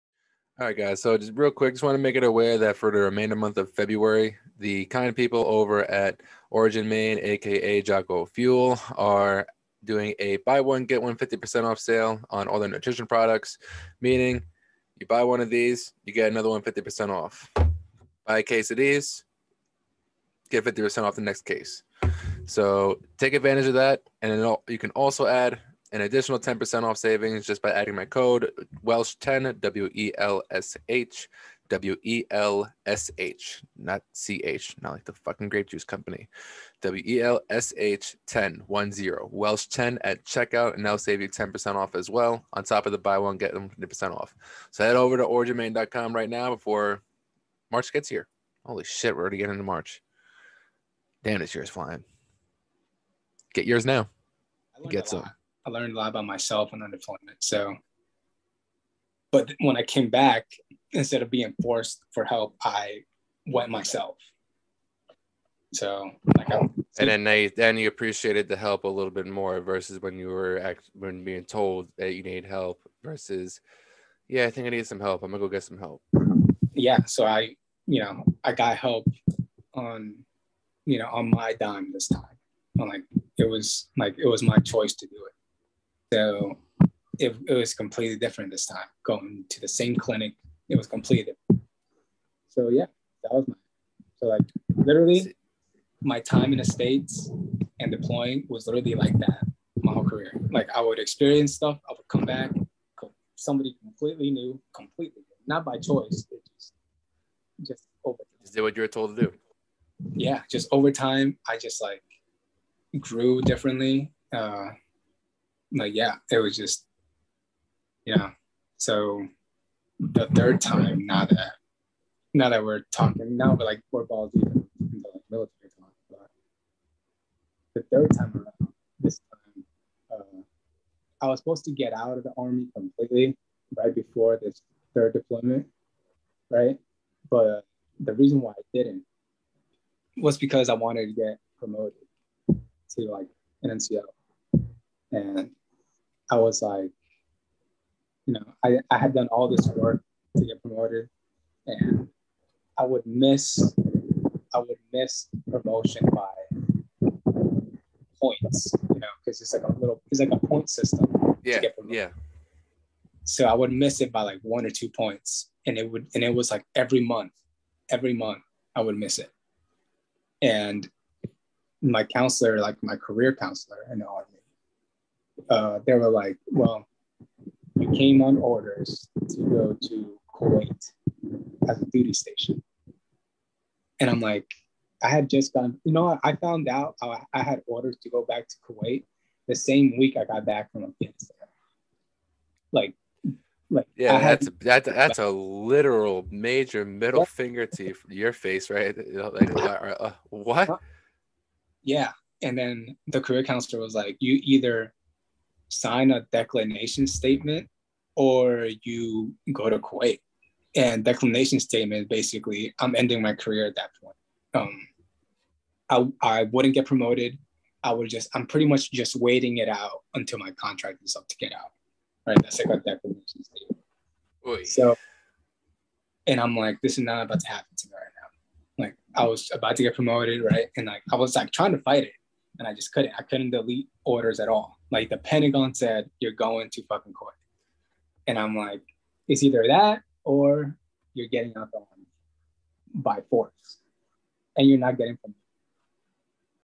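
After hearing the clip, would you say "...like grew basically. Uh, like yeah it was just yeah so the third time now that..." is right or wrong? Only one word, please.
wrong.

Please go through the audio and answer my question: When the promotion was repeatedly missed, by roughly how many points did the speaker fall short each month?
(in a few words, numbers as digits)
1 or 2.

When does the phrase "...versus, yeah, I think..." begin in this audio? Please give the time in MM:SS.
01:13.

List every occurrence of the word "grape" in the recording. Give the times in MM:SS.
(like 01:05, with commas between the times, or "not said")
00:35.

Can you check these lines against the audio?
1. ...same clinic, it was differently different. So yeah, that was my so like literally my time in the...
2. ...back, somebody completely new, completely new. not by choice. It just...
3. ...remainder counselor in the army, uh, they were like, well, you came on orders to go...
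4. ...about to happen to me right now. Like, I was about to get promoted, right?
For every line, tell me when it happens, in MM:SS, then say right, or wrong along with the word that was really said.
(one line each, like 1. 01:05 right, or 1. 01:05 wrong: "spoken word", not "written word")
1. 01:29 wrong: "completely", not "differently"
2. 01:42 right
3. 02:52 wrong: "career", not "remainder"
4. 03:47 right.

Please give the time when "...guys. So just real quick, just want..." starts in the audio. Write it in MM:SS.
00:00.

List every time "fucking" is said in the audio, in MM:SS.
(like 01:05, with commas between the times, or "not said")
00:35, 03:56.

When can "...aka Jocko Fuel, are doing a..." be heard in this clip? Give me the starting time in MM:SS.
00:07.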